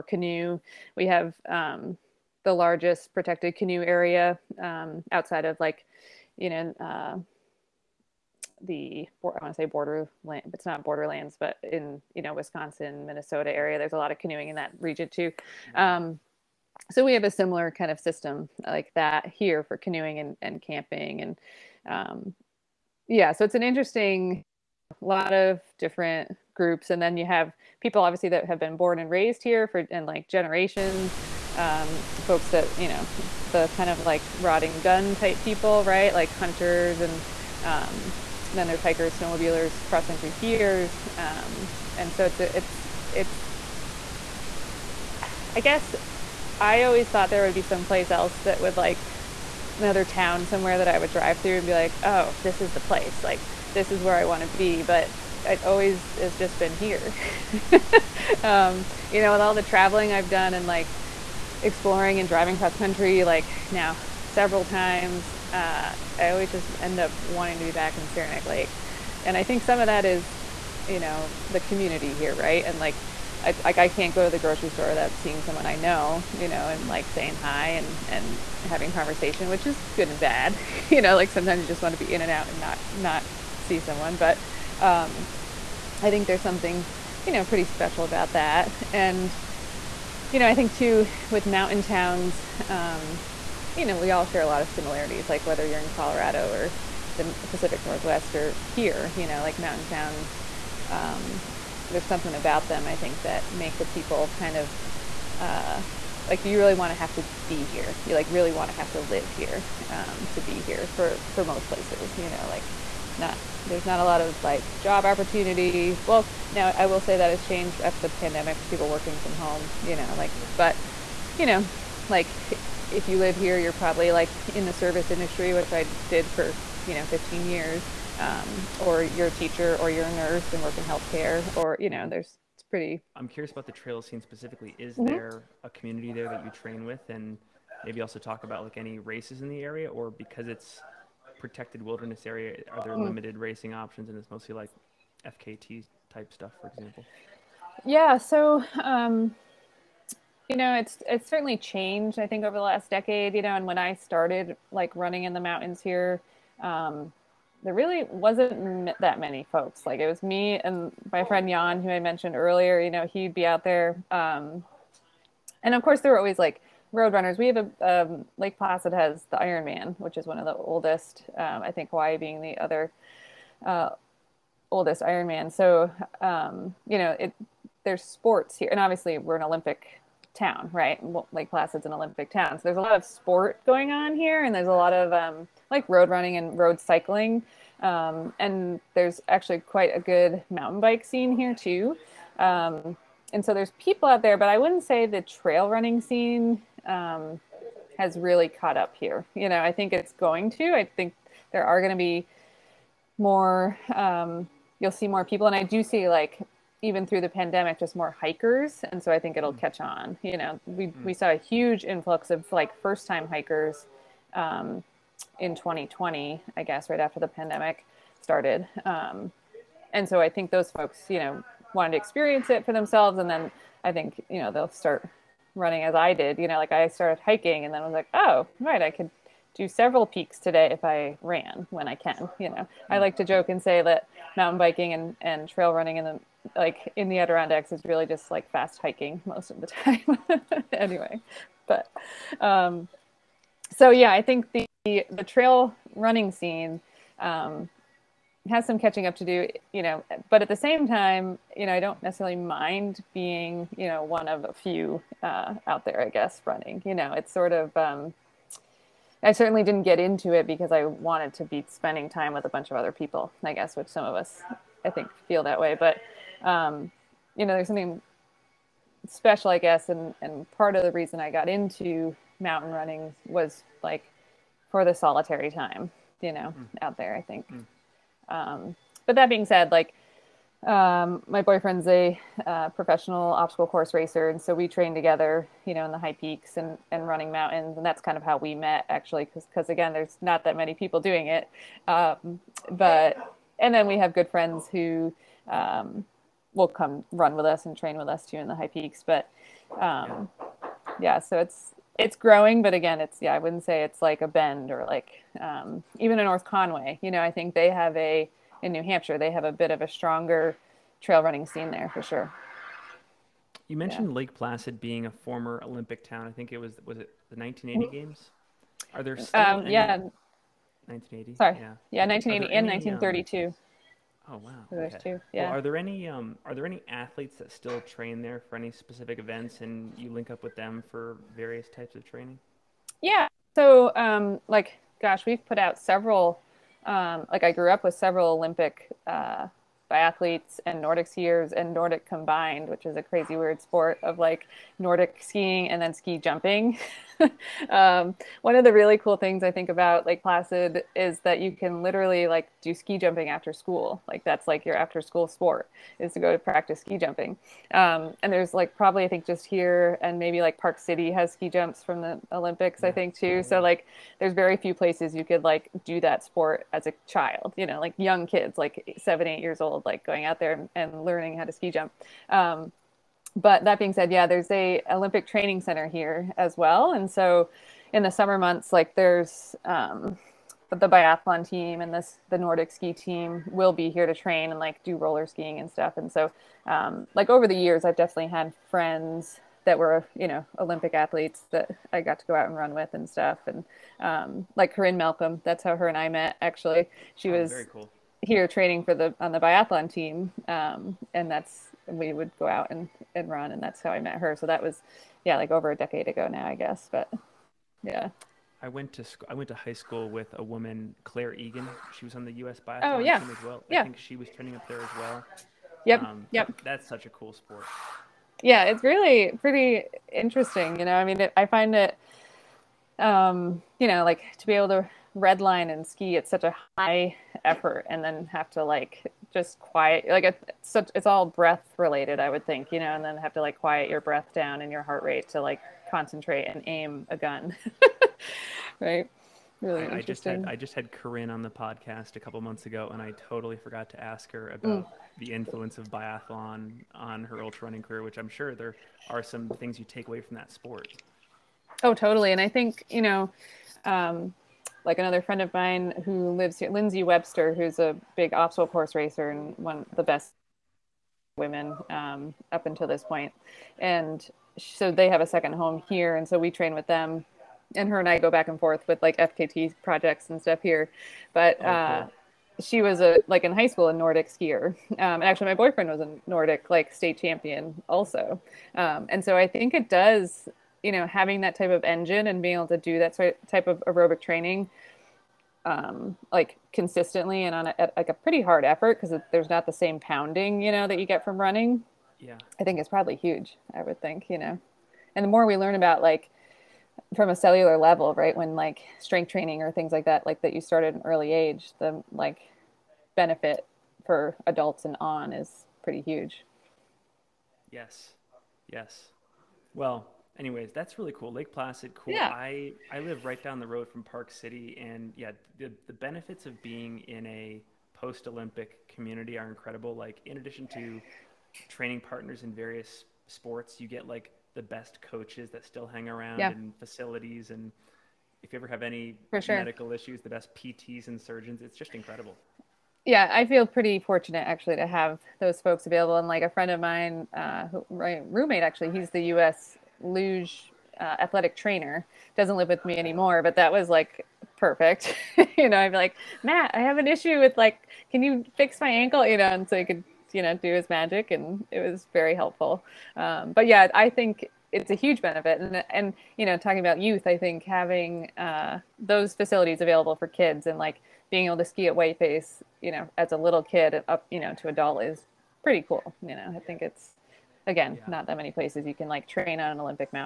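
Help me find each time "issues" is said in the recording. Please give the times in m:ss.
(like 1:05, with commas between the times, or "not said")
8:49, 9:07.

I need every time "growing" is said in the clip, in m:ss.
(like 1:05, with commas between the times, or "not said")
5:02.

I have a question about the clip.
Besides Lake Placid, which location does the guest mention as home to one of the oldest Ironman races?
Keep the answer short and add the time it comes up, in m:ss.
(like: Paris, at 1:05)
Hawaii, at 2:51.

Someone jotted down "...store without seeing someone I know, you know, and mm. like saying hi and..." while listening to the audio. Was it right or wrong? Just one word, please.
right.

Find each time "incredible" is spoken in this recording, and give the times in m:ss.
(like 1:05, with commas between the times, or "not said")
8:39, 8:51.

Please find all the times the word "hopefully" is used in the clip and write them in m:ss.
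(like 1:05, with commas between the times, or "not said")
not said.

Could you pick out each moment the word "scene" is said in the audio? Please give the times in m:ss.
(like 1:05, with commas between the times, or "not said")
2:14, 3:11, 3:16, 4:06, 5:11.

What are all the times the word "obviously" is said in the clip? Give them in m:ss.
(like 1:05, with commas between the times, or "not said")
0:28, 2:58.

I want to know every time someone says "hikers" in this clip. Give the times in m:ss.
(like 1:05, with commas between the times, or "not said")
0:38, 3:28, 3:33.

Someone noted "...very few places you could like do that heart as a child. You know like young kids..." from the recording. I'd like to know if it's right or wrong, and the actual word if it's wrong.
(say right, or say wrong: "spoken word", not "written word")
wrong: "sport", not "heart".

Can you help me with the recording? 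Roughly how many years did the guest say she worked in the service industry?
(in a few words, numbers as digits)
15 years.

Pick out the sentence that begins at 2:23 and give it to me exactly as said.
limited racing options, and it's mostly like FKT type stuff, for example?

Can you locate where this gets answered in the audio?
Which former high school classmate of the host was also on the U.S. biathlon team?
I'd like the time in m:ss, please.
6:51.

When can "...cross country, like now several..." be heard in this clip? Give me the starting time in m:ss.
1:02.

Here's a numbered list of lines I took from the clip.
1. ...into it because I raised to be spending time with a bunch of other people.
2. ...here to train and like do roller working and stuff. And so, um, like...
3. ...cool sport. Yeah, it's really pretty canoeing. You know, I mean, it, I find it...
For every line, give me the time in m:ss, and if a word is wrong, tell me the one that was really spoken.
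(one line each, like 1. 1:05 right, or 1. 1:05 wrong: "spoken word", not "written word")
1. 4:19 wrong: "wanted", not "raised"
2. 6:23 wrong: "skiing", not "working"
3. 6:57 wrong: "interesting", not "canoeing".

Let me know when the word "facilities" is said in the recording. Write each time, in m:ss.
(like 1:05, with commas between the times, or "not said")
8:46, 9:19.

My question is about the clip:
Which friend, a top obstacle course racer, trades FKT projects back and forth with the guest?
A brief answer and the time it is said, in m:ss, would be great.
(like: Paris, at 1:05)
Lindsay Webster, at 7:36.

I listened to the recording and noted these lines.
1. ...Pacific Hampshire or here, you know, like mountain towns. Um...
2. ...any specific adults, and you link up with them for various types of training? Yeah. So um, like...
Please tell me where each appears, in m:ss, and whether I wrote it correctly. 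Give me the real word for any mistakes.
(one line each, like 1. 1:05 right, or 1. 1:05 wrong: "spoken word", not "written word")
1. 1:37 wrong: "Northwest", not "Hampshire"
2. 5:28 wrong: "events", not "adults".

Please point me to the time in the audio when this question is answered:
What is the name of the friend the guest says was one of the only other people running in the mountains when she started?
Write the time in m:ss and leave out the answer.
2:41.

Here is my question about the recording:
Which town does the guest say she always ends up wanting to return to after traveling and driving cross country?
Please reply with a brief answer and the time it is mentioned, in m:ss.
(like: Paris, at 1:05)
Saranac Lake, at 1:08.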